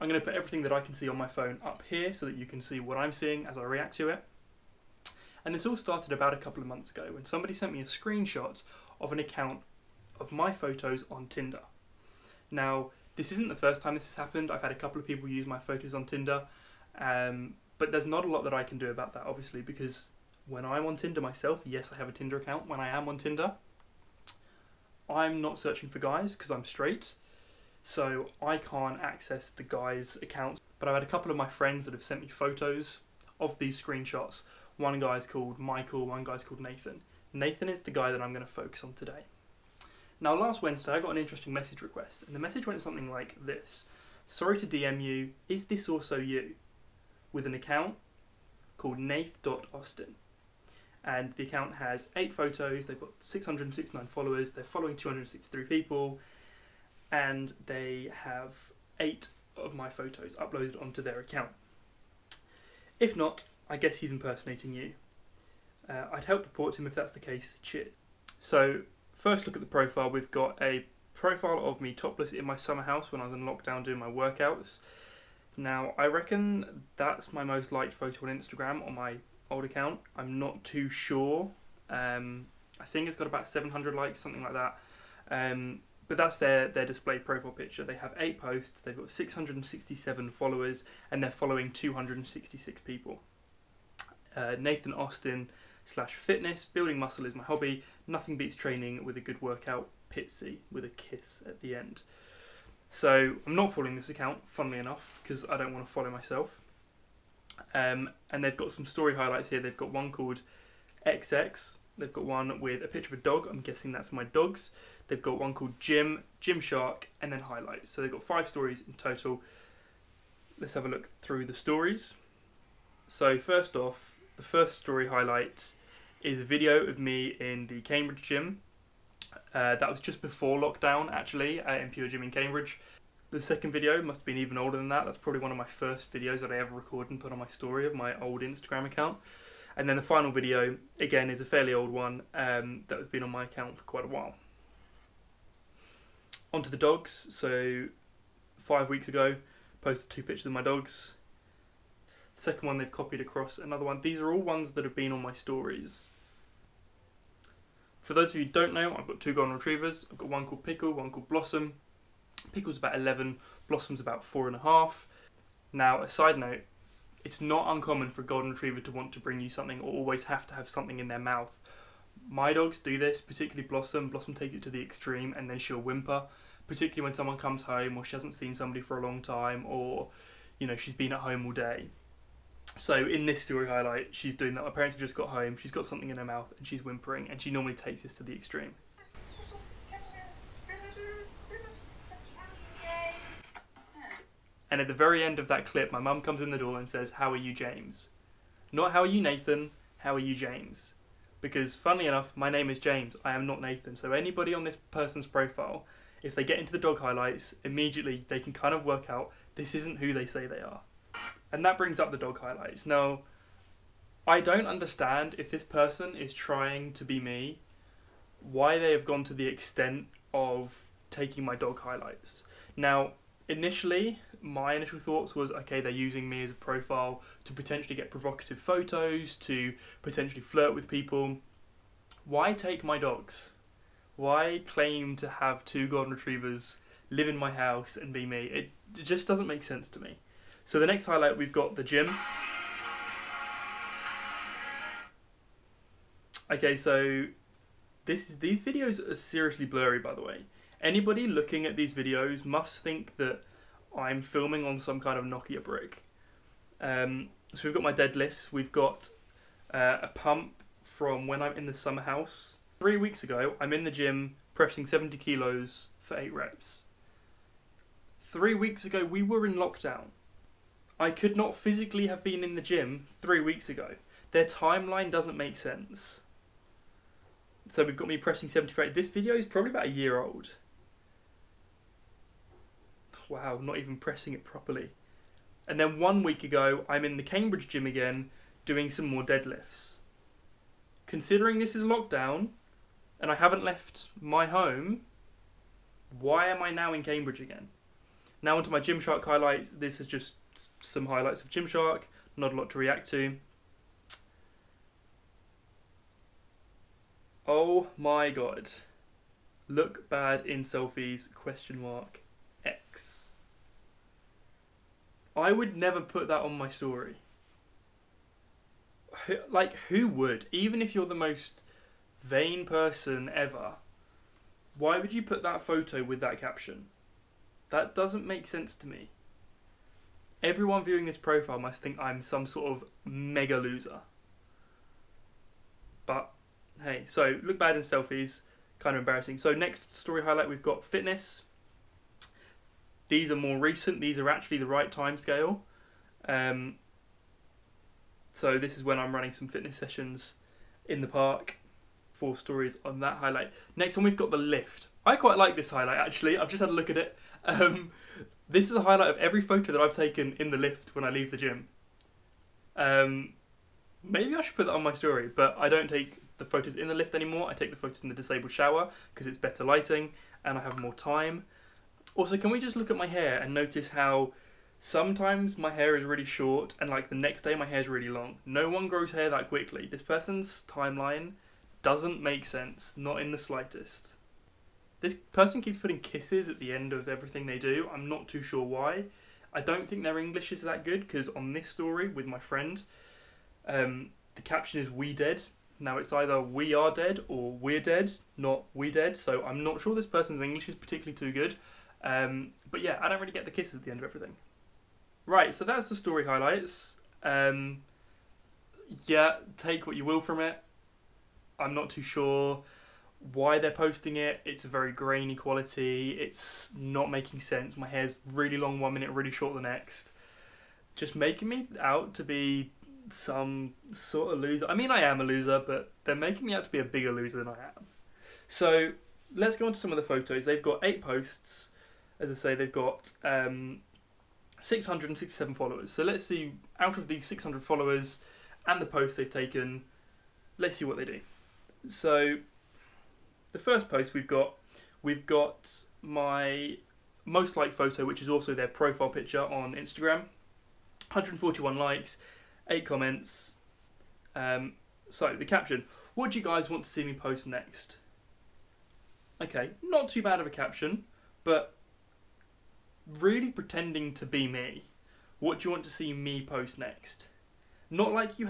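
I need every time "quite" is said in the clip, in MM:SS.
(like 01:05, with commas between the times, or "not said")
02:23, 05:55.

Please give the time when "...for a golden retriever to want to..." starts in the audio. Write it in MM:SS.
02:48.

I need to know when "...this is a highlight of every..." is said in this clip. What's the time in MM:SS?
05:58.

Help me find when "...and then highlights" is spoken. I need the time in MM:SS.
01:57.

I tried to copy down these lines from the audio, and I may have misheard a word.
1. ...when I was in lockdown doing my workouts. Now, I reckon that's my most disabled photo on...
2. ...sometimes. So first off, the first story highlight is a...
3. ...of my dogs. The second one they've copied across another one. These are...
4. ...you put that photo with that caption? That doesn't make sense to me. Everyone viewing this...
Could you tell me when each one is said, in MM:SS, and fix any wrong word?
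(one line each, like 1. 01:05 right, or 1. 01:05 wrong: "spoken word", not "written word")
1. 01:13 wrong: "liked", not "disabled"
2. 02:01 wrong: "stories", not "sometimes"
3. 02:30 right
4. 05:25 right.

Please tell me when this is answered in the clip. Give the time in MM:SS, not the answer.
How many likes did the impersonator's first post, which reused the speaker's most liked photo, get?
07:31.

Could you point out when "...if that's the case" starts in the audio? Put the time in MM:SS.
01:06.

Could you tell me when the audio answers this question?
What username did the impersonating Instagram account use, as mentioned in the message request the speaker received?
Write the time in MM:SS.
00:48.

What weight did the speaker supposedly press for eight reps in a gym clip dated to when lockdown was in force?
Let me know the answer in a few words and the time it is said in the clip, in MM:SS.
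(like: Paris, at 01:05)
70 kilos, at 04:24.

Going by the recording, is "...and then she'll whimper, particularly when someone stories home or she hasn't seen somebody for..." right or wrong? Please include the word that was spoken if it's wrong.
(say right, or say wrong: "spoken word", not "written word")
wrong: "comes", not "stories".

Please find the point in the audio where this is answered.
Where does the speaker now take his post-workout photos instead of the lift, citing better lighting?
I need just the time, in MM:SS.
06:08.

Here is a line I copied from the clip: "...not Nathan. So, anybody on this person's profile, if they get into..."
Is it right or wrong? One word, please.
right.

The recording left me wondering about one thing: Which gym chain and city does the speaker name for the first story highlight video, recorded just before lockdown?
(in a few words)
PureGym in Cambridge.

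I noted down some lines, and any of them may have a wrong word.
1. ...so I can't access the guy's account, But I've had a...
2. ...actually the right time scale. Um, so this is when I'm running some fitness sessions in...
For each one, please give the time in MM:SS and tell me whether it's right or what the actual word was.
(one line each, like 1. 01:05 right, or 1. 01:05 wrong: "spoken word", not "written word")
1. 00:27 right
2. 05:44 right.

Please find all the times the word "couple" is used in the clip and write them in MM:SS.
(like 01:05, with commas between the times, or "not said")
00:06, 00:14, 00:31.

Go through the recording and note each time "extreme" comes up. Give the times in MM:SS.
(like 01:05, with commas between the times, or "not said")
02:54, 03:08.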